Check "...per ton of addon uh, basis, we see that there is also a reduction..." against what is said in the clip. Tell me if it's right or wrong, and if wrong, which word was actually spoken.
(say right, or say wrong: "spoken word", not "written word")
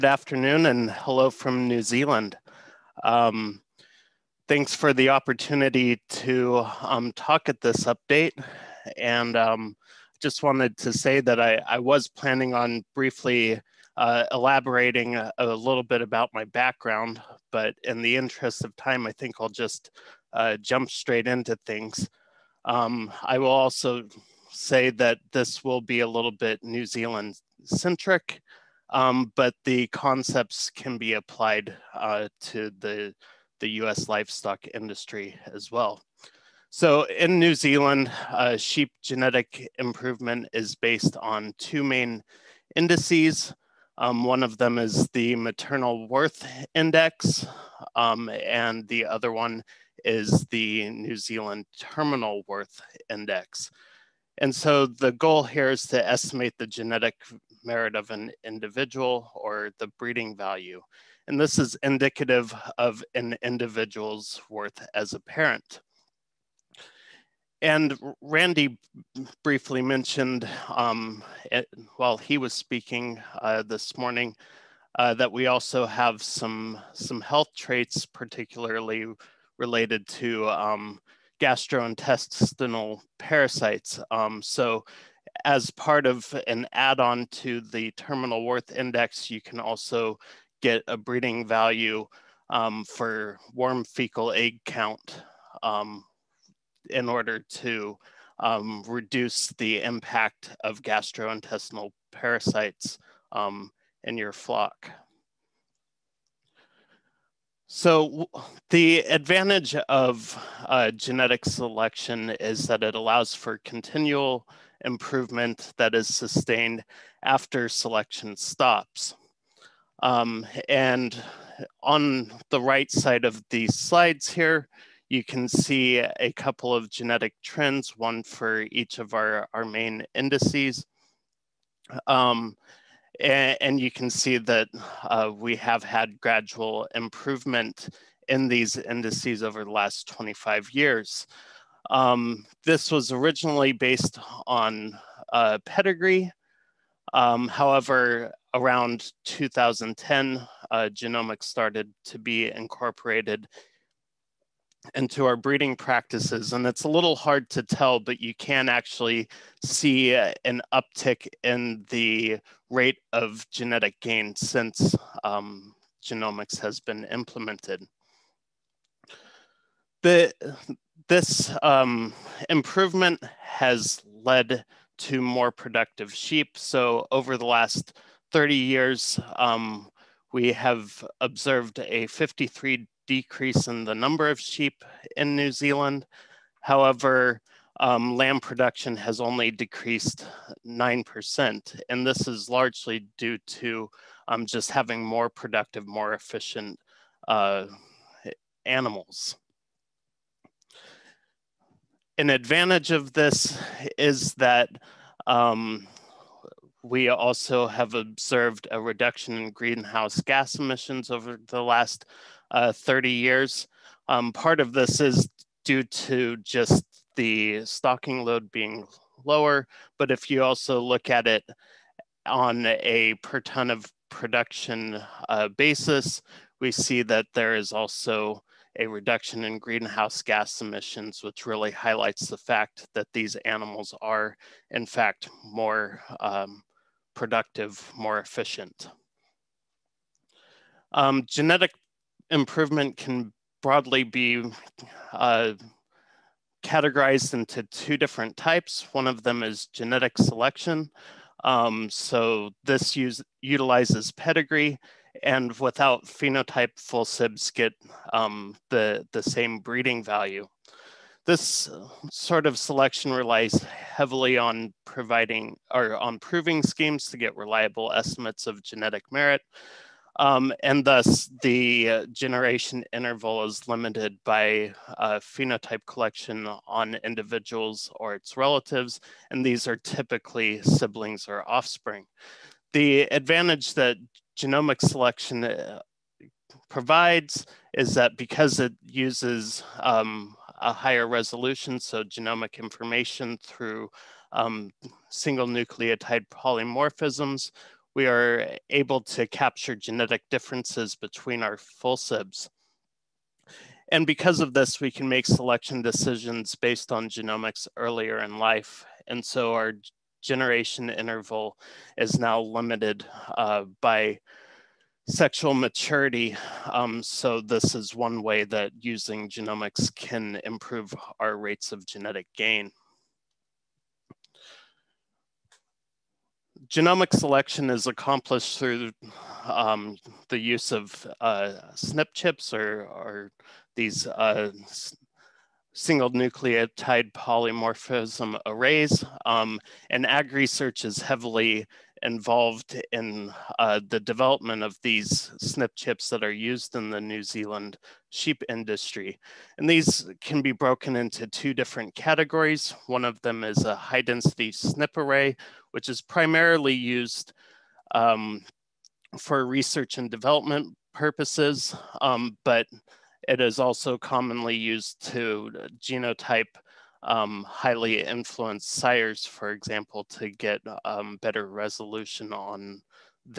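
wrong: "production", not "addon".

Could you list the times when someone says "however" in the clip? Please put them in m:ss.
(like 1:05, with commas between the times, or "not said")
2:27, 3:06.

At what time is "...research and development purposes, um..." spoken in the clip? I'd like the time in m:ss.
5:59.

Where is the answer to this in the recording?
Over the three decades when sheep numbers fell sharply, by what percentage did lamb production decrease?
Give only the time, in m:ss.
3:10.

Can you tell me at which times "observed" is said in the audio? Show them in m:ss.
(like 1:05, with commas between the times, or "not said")
3:01, 3:27.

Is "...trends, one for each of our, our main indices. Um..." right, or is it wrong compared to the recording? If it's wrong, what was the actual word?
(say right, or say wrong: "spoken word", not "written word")
right.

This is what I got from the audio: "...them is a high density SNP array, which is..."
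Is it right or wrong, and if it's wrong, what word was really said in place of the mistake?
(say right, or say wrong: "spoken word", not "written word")
right.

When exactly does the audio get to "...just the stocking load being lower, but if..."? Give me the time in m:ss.
3:36.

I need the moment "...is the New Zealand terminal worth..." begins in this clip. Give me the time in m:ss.
0:50.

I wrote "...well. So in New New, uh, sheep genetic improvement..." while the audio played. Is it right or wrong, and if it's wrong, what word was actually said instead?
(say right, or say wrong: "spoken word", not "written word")
wrong: "Zealand", not "New".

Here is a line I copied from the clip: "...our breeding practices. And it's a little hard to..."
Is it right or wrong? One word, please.
right.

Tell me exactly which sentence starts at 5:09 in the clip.
And so our generation interval is now limited uh, by sexual maturity.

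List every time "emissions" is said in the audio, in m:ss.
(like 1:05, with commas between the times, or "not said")
3:30, 3:50.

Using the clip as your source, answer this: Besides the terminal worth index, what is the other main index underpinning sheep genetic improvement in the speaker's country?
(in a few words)
Maternal worth index.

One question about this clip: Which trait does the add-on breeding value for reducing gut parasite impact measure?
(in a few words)
Worm fecal egg count.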